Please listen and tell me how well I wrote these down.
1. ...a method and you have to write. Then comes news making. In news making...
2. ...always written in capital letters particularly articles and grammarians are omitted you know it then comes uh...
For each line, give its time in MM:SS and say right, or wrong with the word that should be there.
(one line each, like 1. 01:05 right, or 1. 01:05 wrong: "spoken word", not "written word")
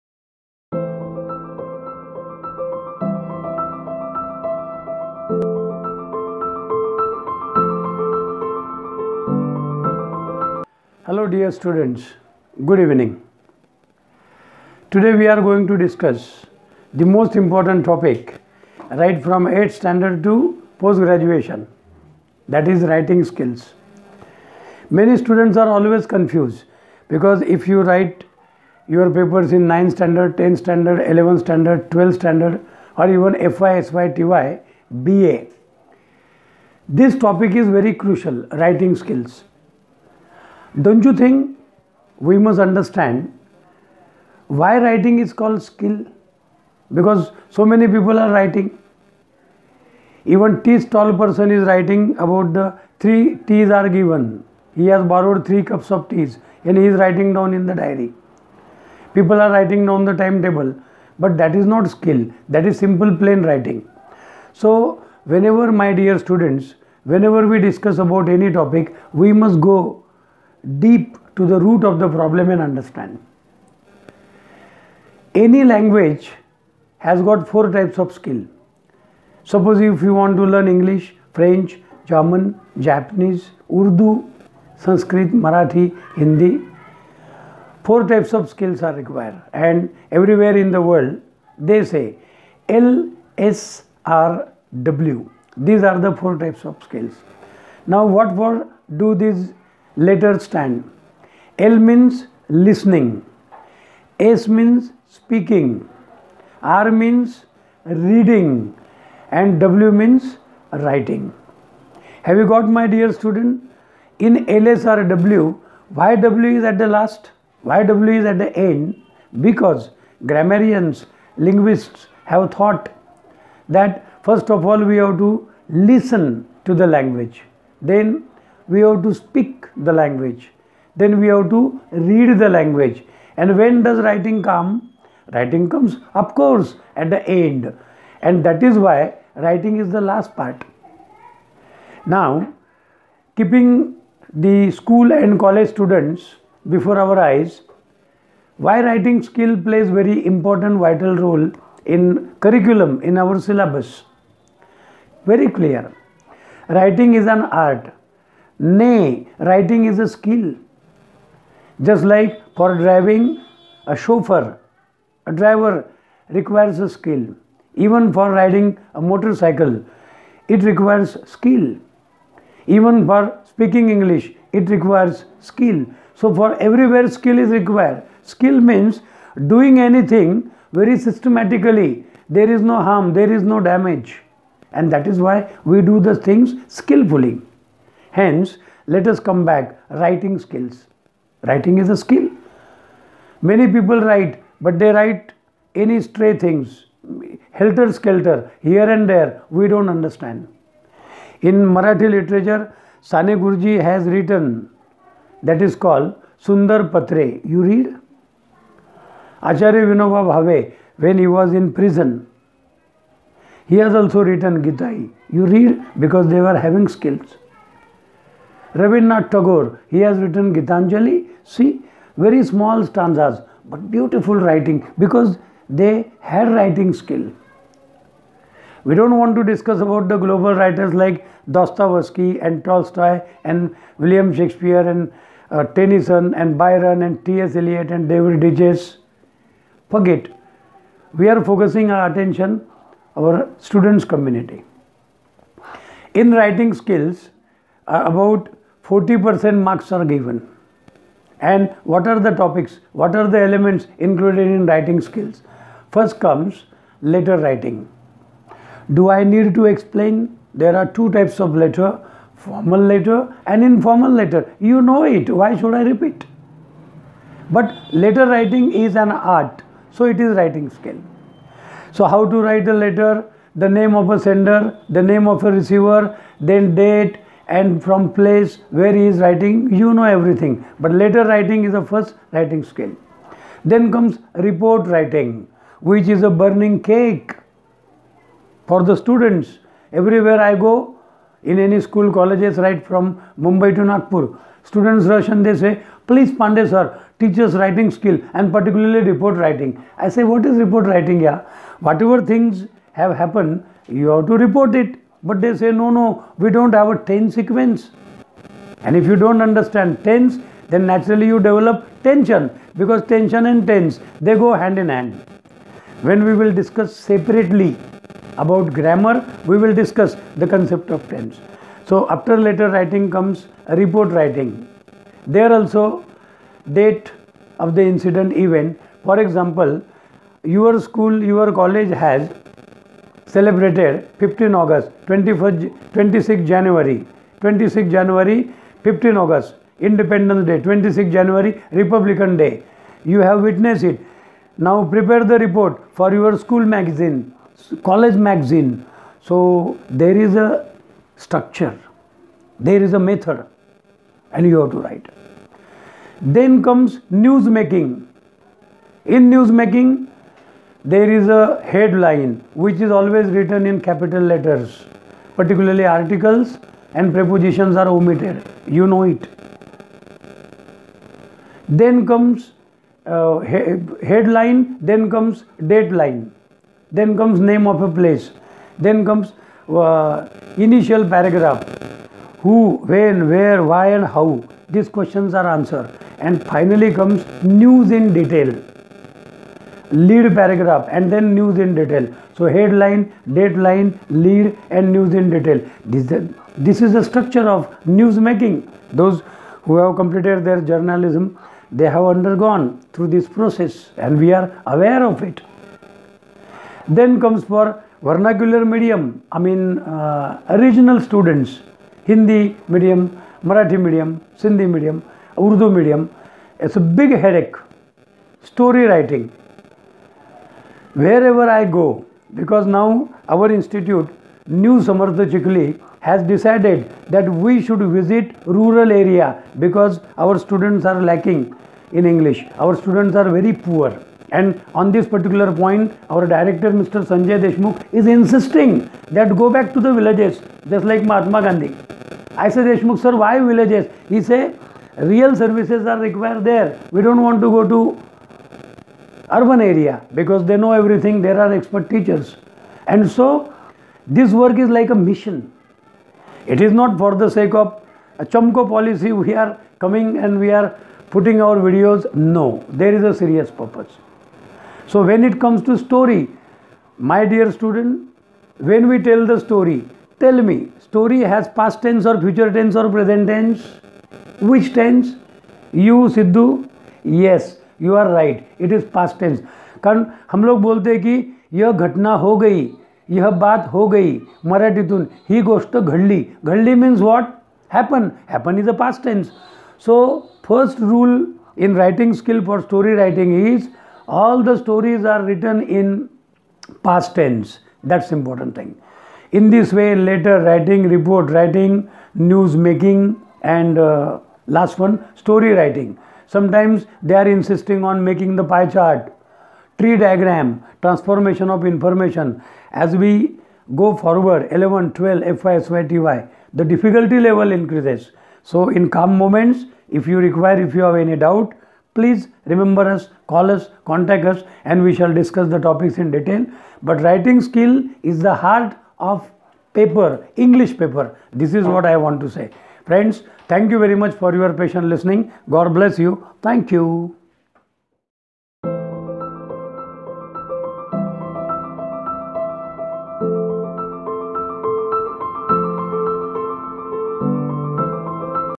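1. 05:52 right
2. 06:02 wrong: "prepositions", not "grammarians".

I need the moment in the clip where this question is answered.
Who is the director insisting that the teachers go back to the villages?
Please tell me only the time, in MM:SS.
07:16.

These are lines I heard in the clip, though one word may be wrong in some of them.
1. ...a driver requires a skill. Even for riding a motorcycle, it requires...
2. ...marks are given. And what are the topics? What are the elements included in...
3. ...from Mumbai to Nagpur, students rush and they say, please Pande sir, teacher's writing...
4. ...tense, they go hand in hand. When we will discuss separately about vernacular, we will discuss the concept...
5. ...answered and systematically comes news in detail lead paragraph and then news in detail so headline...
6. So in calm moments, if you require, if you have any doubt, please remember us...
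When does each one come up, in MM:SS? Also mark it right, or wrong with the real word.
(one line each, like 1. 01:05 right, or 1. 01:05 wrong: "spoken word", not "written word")
1. 02:45 right
2. 04:09 right
3. 04:52 right
4. 05:13 wrong: "grammar", not "vernacular"
5. 06:25 wrong: "finally", not "systematically"
6. 08:38 right.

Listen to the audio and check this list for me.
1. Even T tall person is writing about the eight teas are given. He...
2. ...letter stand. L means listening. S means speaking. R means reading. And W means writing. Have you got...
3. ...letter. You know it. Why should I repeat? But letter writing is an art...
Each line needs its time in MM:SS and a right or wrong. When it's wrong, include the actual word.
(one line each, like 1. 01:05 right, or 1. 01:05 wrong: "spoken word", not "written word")
1. 00:50 wrong: "three", not "eight"
2. 01:39 right
3. 04:24 right.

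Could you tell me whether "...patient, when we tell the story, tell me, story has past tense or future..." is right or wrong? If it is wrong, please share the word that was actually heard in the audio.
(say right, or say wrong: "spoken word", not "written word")
wrong: "student", not "patient".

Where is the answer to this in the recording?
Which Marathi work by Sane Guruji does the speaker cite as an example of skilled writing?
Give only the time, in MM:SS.
03:26.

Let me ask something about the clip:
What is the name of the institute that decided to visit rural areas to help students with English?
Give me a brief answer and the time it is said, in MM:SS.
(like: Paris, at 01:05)
New Samartha Chikli, at 07:04.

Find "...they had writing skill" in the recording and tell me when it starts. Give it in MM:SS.
03:45.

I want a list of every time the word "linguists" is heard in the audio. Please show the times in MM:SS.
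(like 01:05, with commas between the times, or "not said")
02:01.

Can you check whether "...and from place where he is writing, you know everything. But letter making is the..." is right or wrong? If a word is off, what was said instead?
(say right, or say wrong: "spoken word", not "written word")
wrong: "writing", not "making".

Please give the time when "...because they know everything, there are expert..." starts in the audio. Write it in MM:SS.
07:30.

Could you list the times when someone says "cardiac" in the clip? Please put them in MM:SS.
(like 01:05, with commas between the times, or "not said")
not said.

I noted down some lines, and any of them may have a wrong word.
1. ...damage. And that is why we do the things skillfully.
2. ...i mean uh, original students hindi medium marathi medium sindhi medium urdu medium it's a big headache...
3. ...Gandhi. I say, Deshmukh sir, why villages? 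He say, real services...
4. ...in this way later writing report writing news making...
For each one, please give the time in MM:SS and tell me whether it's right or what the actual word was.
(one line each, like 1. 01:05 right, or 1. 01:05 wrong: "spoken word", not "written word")
1. 03:03 right
2. 06:49 right
3. 07:21 right
4. 08:19 right.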